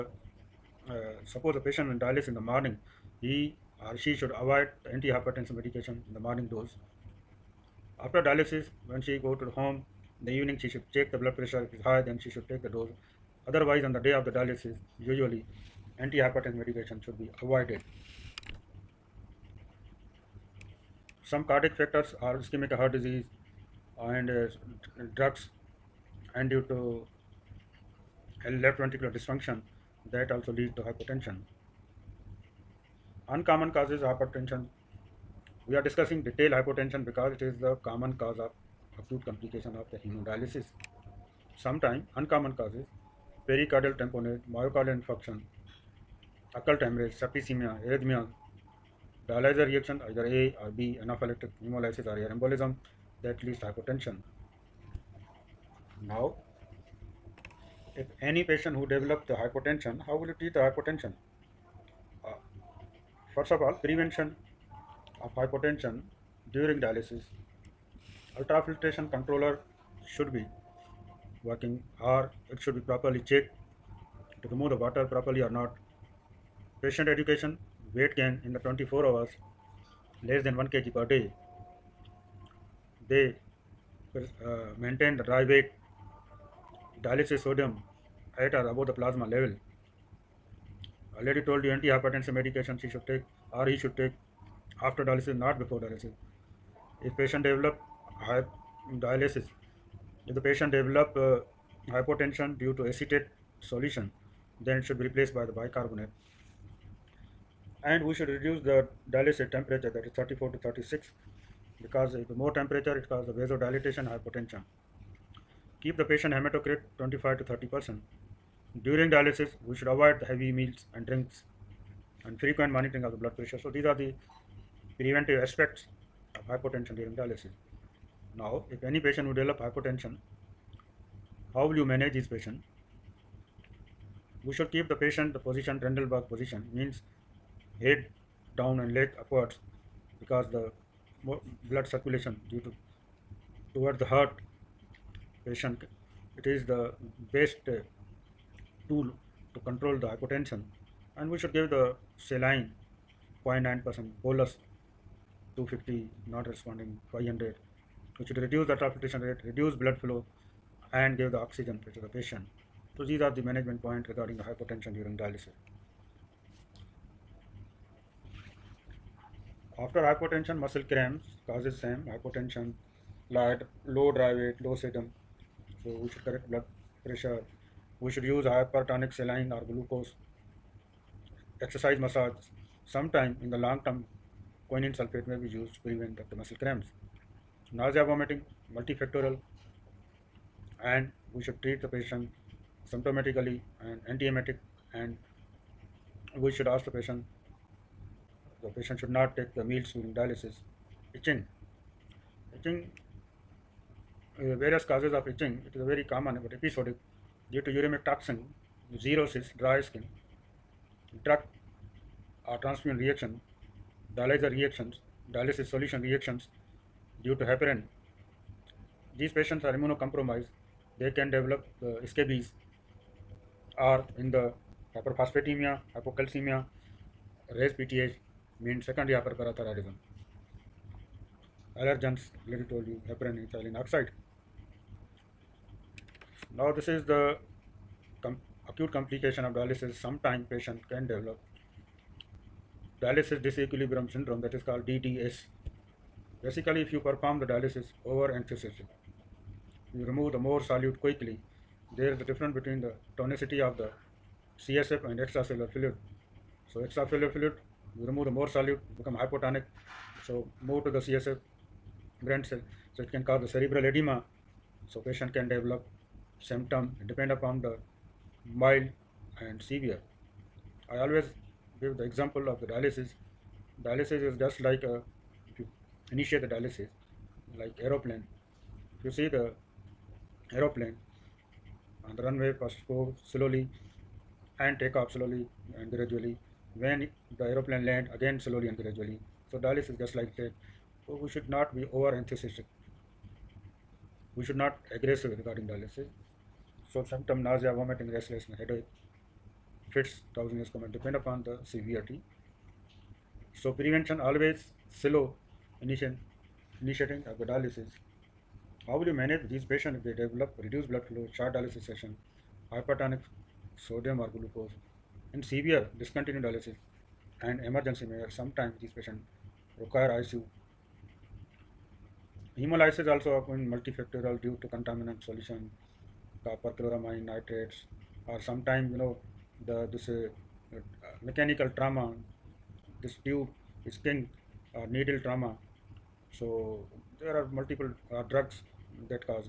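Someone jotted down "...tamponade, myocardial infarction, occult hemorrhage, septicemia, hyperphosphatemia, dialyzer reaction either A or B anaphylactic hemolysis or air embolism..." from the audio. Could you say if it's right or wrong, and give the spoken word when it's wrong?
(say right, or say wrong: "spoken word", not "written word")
wrong: "arrhythmia", not "hyperphosphatemia".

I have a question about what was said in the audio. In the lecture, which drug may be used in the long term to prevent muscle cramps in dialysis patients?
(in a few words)
Quinine sulfate.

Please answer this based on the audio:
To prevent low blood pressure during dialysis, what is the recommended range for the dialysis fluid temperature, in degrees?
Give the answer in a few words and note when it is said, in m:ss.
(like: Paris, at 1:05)
34 to 36, at 1:50.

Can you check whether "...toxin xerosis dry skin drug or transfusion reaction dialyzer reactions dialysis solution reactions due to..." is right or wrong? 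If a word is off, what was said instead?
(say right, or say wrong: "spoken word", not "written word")
right.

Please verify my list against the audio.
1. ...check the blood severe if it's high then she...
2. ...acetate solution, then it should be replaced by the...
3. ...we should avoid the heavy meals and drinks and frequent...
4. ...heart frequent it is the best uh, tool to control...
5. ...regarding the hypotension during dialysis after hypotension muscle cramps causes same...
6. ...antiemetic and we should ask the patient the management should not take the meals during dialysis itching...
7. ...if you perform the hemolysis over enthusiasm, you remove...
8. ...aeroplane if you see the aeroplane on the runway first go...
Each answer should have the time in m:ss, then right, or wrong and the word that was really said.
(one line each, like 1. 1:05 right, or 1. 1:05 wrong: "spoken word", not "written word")
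1. 0:10 wrong: "pressure", not "severe"
2. 1:42 right
3. 1:59 right
4. 2:24 wrong: "patient", not "frequent"
5. 2:44 right
6. 3:14 wrong: "patient", not "management"
7. 4:06 wrong: "dialysis", not "hemolysis"
8. 4:37 right.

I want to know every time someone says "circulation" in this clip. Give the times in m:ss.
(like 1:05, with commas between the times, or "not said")
2:21.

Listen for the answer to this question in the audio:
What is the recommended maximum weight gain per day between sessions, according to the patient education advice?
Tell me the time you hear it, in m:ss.
1:20.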